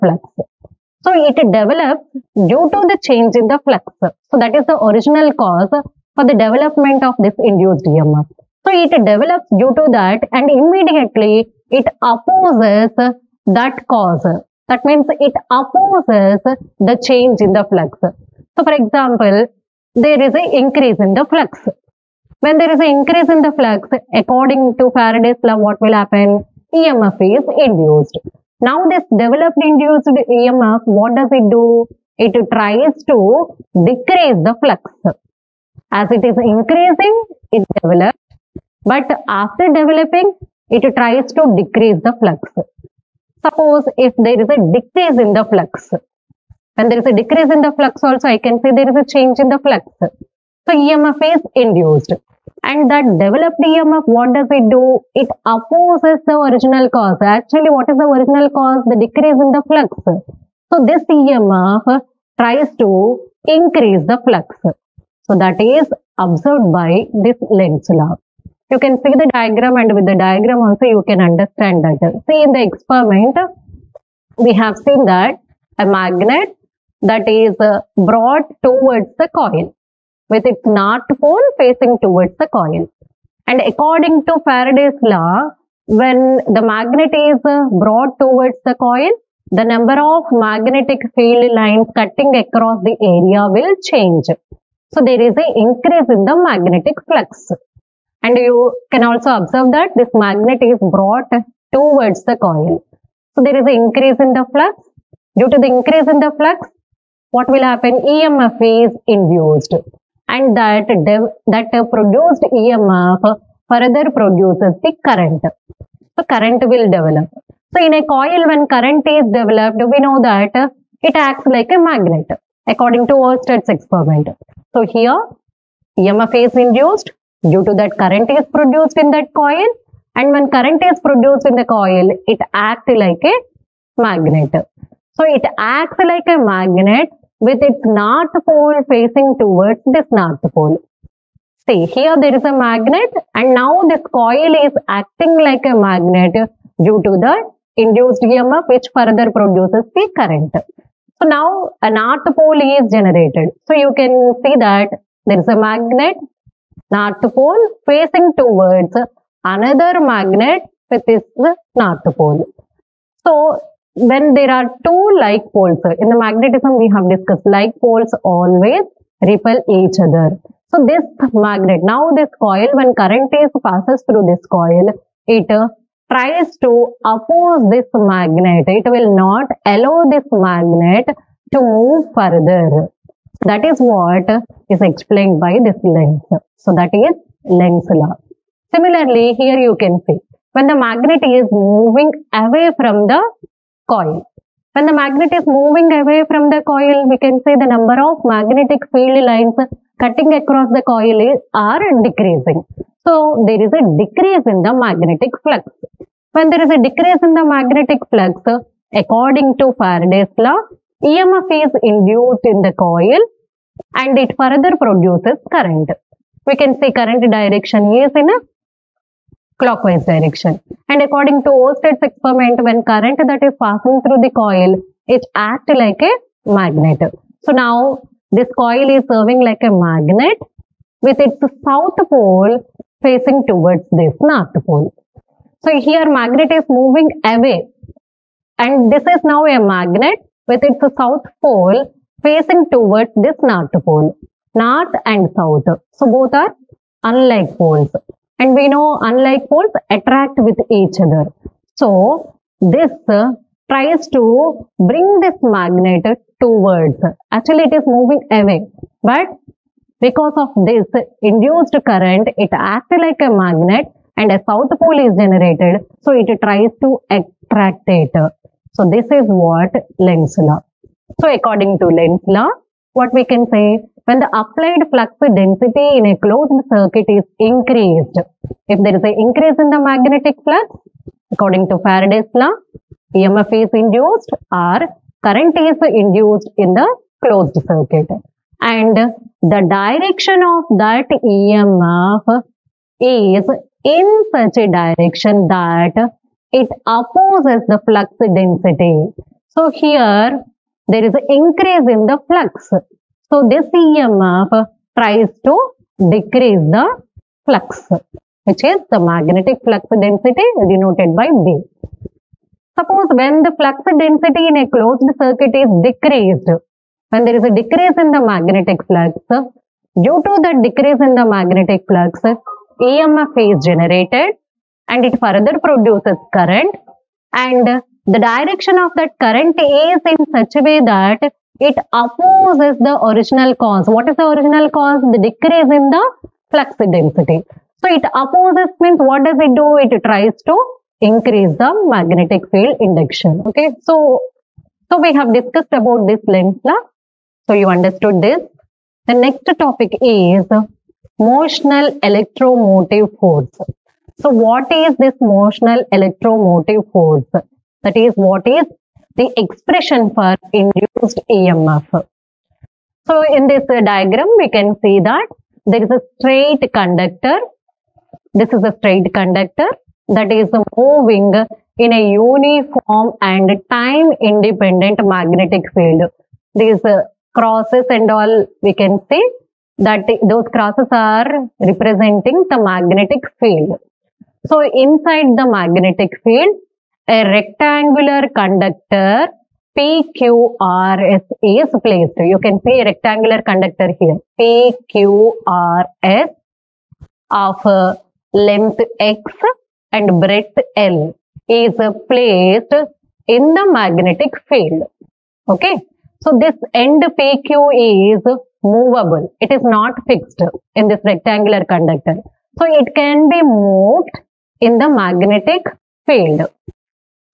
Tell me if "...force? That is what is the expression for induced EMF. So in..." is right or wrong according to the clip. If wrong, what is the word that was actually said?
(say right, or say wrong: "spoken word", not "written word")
right.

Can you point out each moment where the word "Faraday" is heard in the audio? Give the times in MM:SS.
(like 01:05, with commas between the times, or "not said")
00:24, 01:24, 03:29, 04:41.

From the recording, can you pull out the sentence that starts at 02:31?
So now a north pole is generated.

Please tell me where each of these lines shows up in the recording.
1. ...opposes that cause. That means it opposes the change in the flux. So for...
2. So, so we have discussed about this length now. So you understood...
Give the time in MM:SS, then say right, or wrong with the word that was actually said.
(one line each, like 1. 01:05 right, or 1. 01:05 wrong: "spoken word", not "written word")
1. 00:12 right
2. 05:43 right.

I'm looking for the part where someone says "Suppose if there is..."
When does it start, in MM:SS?
00:43.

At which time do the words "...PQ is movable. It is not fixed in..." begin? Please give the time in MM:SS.
06:47.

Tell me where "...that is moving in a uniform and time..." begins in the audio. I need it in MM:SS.
06:10.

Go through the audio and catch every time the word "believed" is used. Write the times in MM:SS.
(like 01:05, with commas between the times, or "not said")
not said.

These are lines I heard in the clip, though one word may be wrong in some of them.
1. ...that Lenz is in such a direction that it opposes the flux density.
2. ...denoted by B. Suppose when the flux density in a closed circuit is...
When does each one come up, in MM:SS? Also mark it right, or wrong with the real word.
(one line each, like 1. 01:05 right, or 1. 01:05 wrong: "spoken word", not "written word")
1. 04:50 wrong: "EMF", not "Lenz"
2. 05:10 right.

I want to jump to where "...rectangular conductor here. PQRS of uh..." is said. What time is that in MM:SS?
06:32.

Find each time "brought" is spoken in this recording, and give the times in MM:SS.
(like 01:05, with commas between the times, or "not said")
01:17, 01:27, 01:40.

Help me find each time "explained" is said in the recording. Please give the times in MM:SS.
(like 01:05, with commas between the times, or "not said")
03:04.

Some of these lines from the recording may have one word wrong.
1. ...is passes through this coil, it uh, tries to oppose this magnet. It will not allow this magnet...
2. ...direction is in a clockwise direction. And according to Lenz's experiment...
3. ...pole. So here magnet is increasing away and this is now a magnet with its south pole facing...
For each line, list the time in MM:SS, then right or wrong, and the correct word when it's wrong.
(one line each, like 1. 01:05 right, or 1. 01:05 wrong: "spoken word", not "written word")
1. 02:53 right
2. 03:37 wrong: "Oersted", not "Lenz"
3. 03:54 wrong: "moving", not "increasing".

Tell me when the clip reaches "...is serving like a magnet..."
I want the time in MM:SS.
03:48.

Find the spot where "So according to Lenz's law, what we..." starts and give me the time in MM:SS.
04:31.